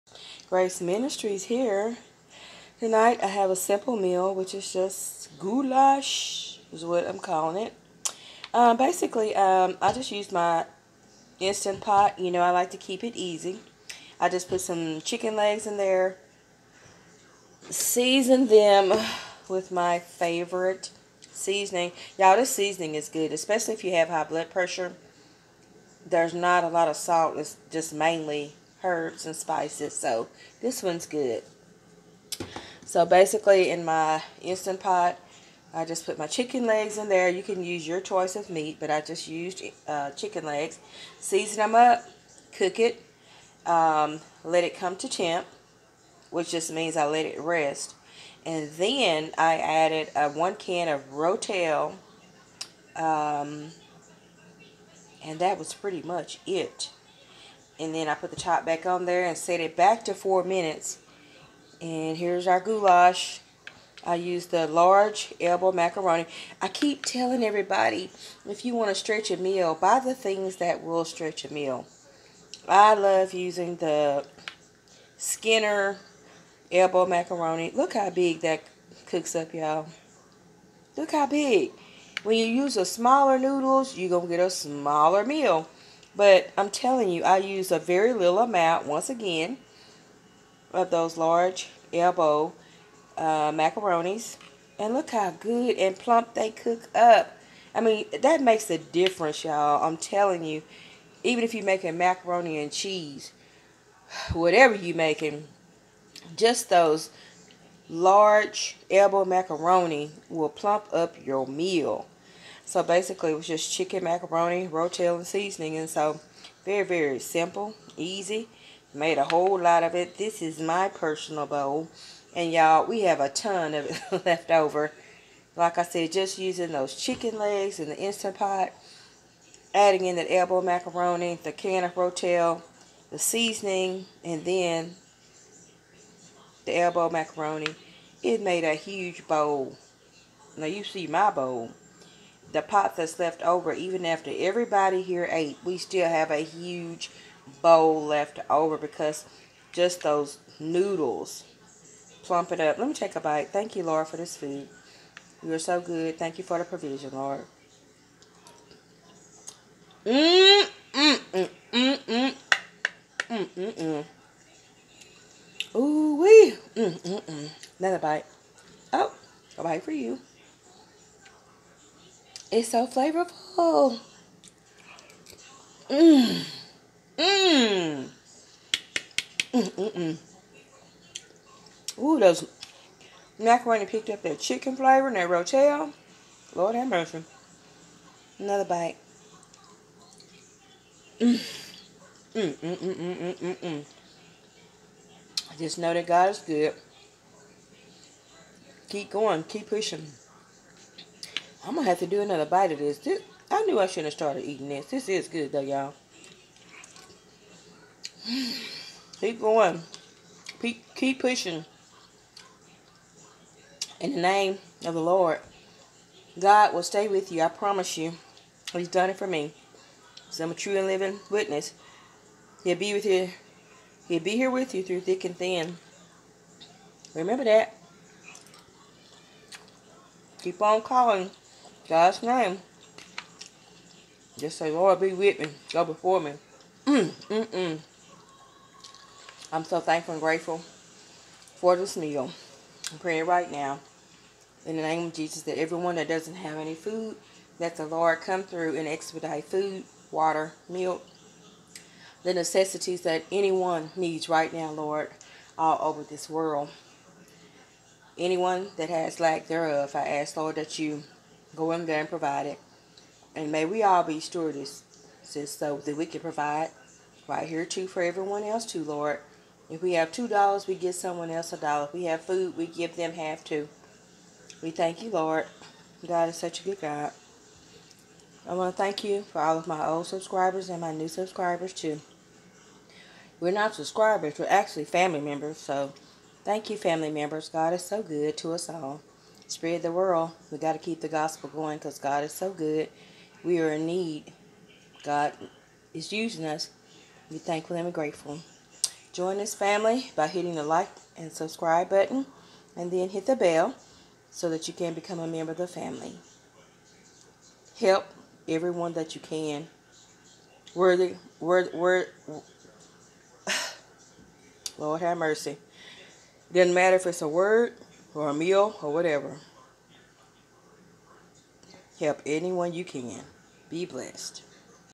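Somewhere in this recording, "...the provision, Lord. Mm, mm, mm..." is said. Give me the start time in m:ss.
2:36.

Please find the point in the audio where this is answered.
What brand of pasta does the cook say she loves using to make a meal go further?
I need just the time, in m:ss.
1:15.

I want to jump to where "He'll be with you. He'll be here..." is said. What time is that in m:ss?
3:42.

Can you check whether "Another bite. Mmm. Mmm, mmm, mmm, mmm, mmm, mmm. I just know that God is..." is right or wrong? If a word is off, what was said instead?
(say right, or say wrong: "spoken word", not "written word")
right.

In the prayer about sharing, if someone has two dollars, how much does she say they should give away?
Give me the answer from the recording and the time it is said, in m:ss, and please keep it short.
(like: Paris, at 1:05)
a dollar, at 4:31.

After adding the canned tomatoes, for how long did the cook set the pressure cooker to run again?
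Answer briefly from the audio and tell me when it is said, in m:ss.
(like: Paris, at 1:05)
4 minutes, at 1:00.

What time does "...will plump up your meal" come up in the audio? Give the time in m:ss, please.
1:50.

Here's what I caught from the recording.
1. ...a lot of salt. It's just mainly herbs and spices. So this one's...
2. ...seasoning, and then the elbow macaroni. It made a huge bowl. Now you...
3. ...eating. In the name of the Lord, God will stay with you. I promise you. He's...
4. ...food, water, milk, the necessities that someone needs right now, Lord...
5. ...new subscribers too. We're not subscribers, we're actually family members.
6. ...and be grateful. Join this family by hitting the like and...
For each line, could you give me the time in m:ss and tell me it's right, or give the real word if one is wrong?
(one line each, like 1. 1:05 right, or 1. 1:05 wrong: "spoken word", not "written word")
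1. 0:26 right
2. 2:13 right
3. 3:31 wrong: "pushing", not "eating"
4. 4:09 wrong: "anyone", not "someone"
5. 4:40 right
6. 4:57 right.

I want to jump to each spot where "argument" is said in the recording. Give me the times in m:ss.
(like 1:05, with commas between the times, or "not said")
not said.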